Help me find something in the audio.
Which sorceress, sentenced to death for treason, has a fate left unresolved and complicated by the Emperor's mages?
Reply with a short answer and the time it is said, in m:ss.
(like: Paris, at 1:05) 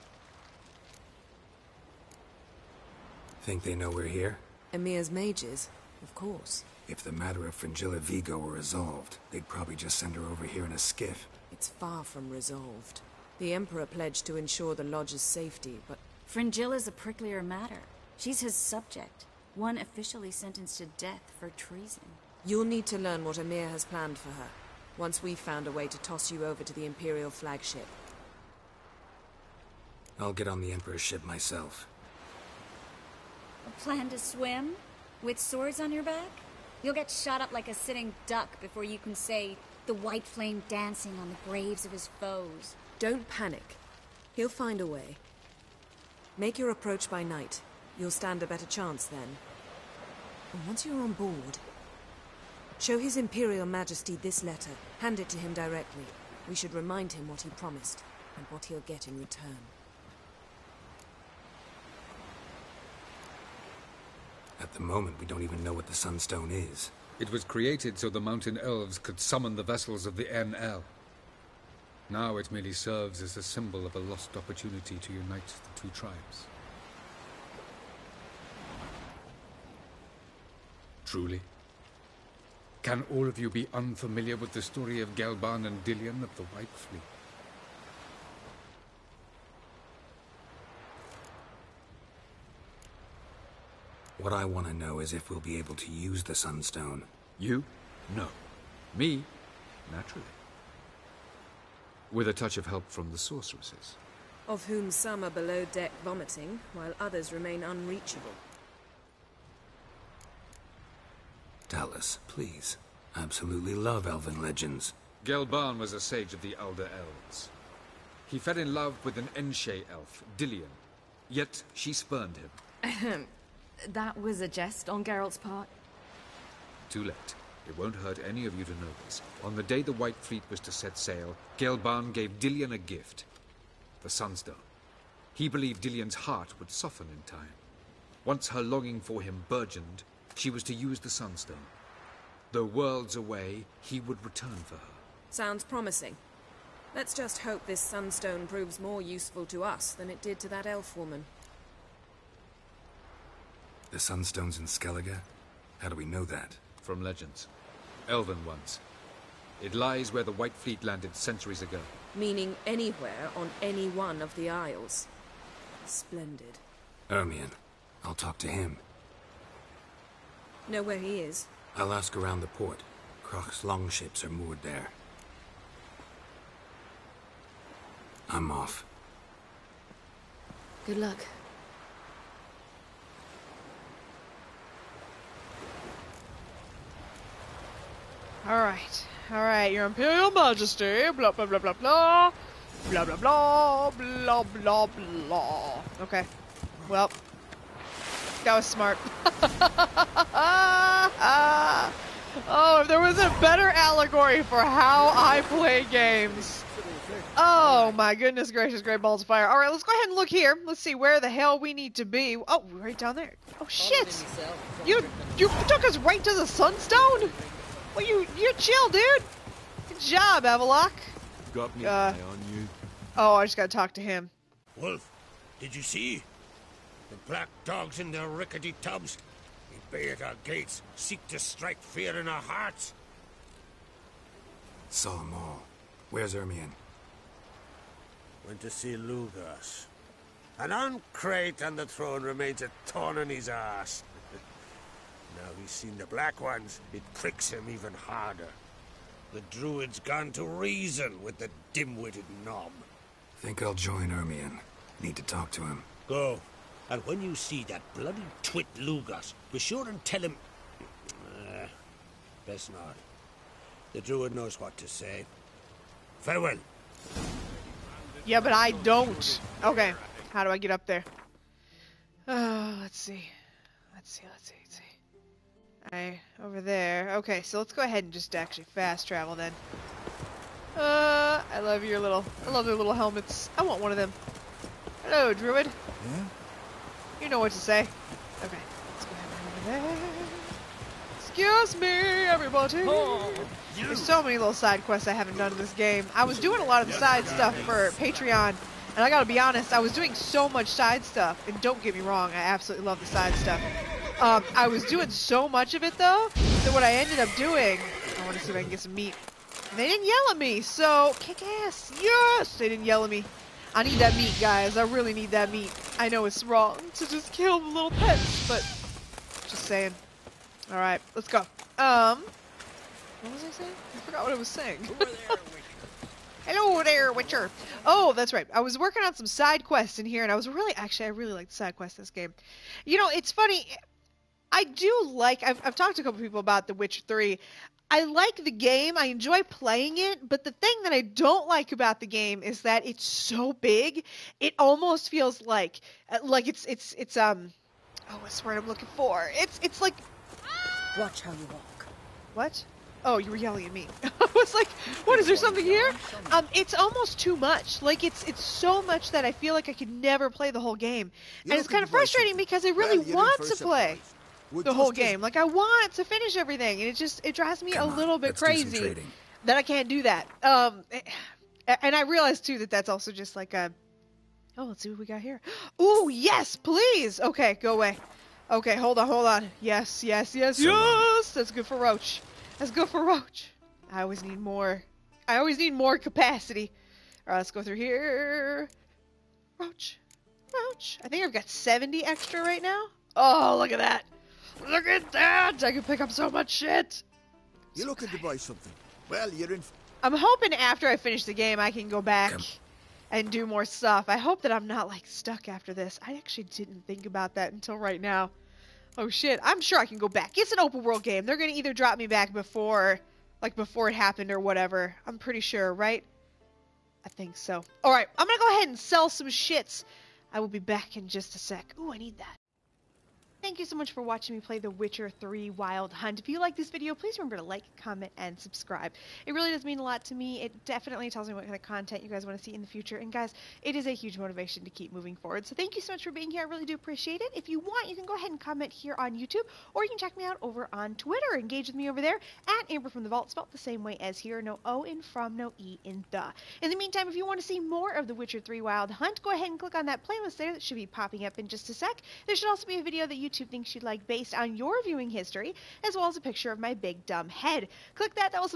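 Fringilla Vigo, at 0:07.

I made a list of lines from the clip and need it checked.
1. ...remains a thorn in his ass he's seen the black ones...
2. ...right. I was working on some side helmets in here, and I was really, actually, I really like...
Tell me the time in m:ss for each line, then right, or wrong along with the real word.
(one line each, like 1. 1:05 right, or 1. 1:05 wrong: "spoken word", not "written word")
1. 4:02 right
2. 5:28 wrong: "quests", not "helmets".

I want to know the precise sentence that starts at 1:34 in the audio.
What I want to know is if we'll be able to use the Sunstone.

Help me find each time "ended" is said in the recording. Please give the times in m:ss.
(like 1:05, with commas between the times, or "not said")
5:06.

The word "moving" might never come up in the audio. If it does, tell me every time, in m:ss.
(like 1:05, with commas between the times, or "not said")
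7:14.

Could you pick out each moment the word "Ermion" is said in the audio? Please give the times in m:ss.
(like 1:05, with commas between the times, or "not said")
2:47, 3:56, 4:14.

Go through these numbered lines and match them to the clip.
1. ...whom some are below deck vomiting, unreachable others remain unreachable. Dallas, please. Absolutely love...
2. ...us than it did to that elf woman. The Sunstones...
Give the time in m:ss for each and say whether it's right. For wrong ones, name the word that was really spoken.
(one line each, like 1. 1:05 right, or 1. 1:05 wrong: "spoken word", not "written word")
1. 1:44 wrong: "while", not "unreachable"
2. 2:29 right.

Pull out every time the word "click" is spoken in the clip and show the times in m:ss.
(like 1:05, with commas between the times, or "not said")
7:29, 7:37.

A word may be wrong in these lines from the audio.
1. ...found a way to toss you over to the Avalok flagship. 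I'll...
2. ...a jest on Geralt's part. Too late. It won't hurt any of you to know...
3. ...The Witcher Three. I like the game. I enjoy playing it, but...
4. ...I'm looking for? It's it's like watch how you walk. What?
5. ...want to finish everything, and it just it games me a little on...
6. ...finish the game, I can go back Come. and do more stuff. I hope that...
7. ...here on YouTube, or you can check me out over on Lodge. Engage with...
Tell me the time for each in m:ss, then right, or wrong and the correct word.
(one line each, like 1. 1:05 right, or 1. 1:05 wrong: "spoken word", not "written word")
1. 0:25 wrong: "Imperial", not "Avalok"
2. 2:04 right
3. 5:36 right
4. 5:48 right
5. 6:05 wrong: "drives", not "games"
6. 6:40 right
7. 7:18 wrong: "Twitter", not "Lodge".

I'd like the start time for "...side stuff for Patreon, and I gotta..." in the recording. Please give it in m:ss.
4:56.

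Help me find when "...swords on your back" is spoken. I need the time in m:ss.
0:35.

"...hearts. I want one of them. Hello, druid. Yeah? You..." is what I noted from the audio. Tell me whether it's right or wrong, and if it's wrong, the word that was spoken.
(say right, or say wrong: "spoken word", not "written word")
wrong: "helmets", not "hearts".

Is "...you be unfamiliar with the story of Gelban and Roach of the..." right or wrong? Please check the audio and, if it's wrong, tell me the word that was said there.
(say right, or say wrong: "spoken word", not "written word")
wrong: "Dillion", not "Roach".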